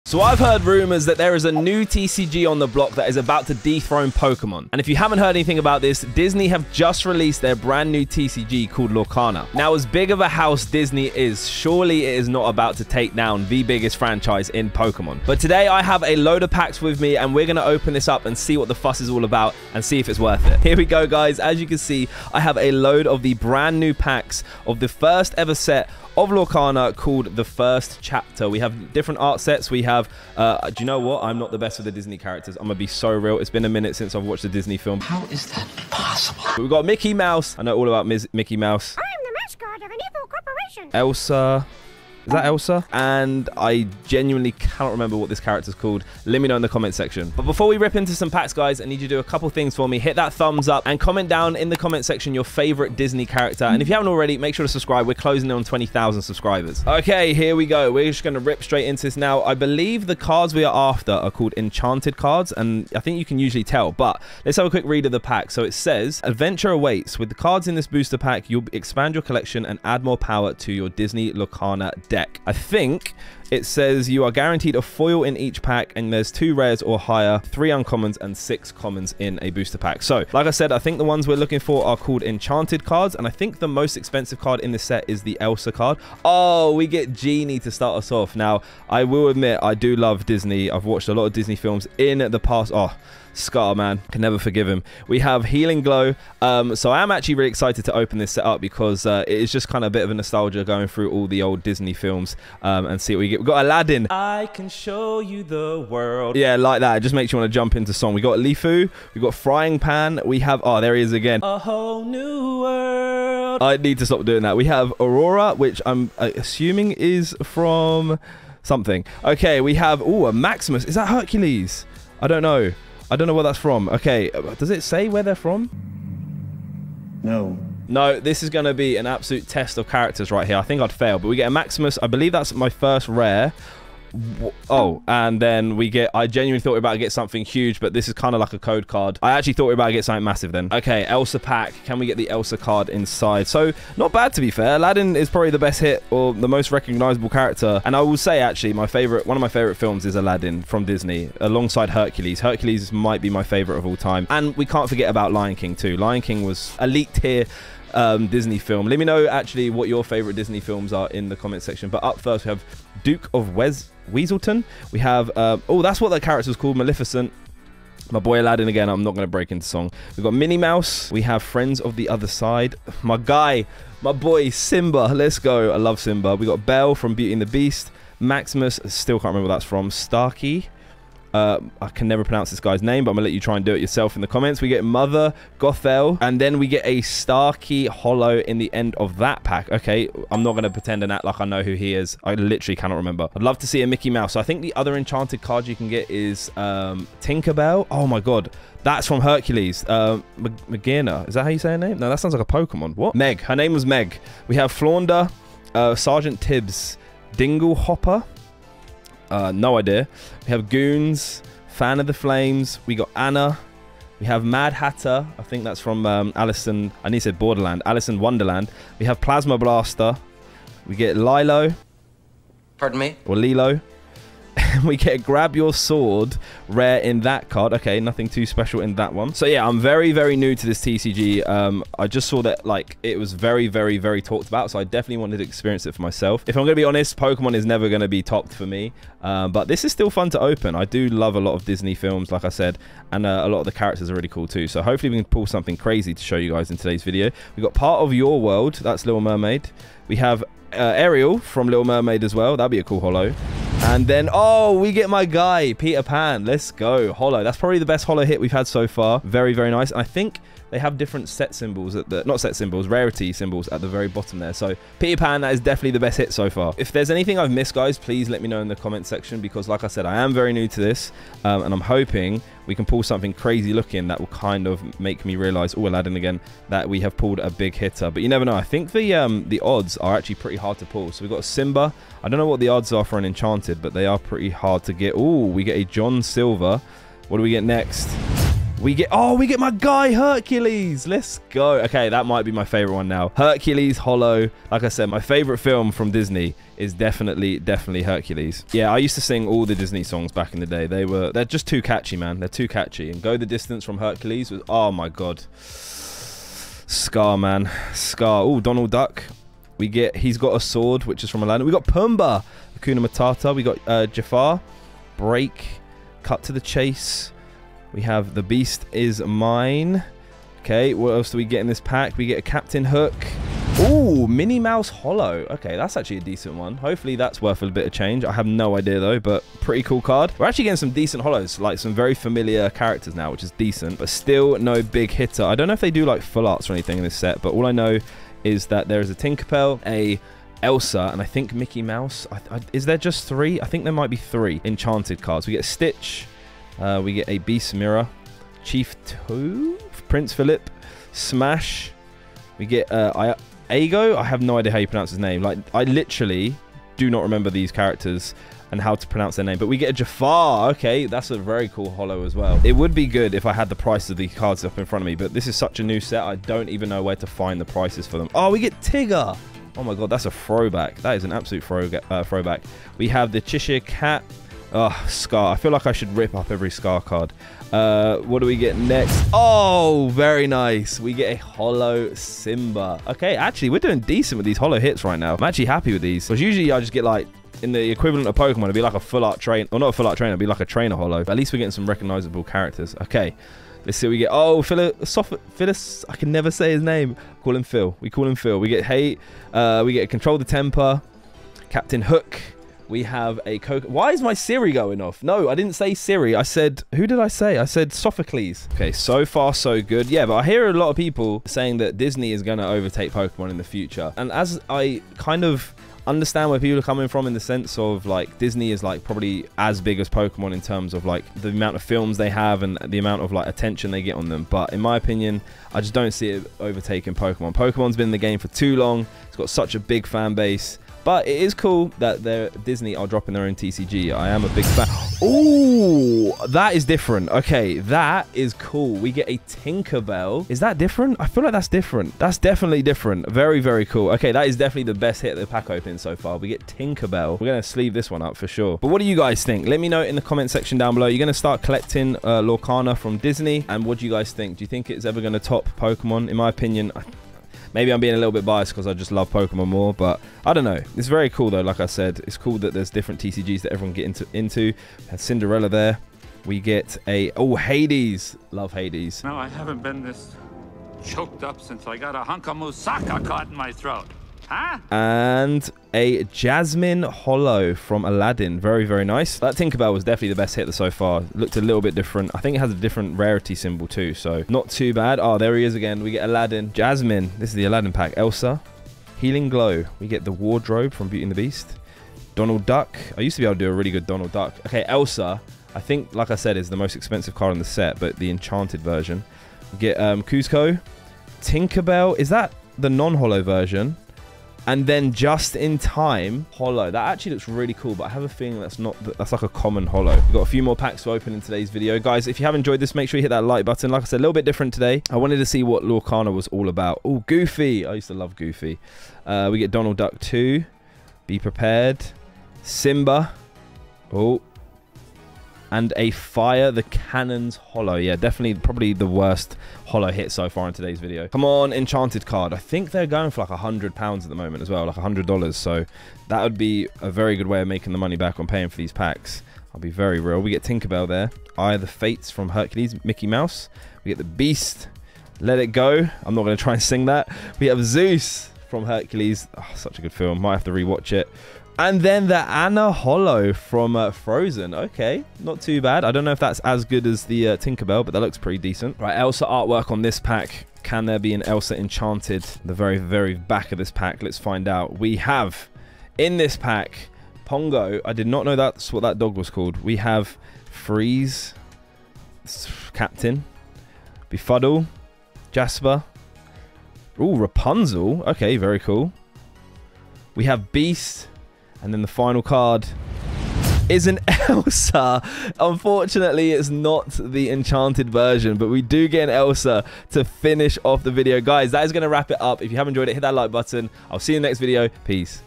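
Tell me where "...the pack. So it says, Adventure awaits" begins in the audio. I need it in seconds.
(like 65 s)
65 s.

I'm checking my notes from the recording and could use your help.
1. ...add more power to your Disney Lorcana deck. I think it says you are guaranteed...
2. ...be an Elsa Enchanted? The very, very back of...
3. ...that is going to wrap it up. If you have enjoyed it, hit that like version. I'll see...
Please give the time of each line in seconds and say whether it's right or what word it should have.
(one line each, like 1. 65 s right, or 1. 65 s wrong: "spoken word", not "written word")
1. 69 s right
2. 561 s right
3. 591 s wrong: "button", not "version".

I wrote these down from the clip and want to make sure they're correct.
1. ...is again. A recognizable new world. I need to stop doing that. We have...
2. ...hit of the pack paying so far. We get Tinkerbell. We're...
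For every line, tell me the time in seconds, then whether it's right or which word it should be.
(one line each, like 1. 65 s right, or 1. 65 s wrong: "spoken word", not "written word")
1. 111 s wrong: "whole", not "recognizable"
2. 445 s wrong: "opening", not "paying".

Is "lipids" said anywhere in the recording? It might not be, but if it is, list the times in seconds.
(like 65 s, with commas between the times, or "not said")
not said.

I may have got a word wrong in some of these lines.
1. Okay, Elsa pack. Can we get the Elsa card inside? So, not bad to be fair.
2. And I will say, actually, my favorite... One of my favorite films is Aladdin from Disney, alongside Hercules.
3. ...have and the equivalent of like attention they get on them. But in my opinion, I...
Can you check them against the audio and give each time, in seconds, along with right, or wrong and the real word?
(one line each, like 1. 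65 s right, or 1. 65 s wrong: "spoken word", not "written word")
1. 140 s right
2. 147 s right
3. 422 s wrong: "amount", not "equivalent".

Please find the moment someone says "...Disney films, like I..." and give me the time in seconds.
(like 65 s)
241 s.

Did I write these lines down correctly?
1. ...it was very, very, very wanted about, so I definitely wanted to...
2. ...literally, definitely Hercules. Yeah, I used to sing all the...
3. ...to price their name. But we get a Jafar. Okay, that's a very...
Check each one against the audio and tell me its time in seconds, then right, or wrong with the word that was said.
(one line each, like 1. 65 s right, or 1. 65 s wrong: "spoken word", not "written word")
1. 233 s wrong: "talked", not "wanted"
2. 296 s wrong: "definitely", not "literally"
3. 358 s wrong: "pronounce", not "price".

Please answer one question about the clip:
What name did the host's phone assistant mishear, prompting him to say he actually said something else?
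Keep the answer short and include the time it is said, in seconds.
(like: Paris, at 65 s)
Sophocles, at 407 s.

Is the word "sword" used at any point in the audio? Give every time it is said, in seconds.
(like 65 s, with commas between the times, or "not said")
225 s, 310 s.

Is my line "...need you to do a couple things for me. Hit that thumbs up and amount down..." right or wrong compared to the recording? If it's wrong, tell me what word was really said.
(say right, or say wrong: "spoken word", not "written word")
wrong: "comment", not "amount".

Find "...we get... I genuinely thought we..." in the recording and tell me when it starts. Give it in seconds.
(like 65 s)
135 s.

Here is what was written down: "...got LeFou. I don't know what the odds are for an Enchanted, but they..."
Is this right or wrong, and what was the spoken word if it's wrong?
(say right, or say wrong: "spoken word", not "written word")
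wrong: "Simba", not "LeFou".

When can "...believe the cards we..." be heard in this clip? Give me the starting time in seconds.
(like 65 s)
59 s.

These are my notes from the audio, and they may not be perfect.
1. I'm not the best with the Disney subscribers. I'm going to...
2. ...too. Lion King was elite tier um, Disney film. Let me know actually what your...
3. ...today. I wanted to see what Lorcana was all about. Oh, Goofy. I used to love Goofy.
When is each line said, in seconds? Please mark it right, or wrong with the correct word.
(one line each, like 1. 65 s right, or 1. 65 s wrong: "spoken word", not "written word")
1. 31 s wrong: "characters", not "subscribers"
2. 155 s right
3. 514 s right.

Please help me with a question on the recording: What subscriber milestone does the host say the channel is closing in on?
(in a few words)
20,000.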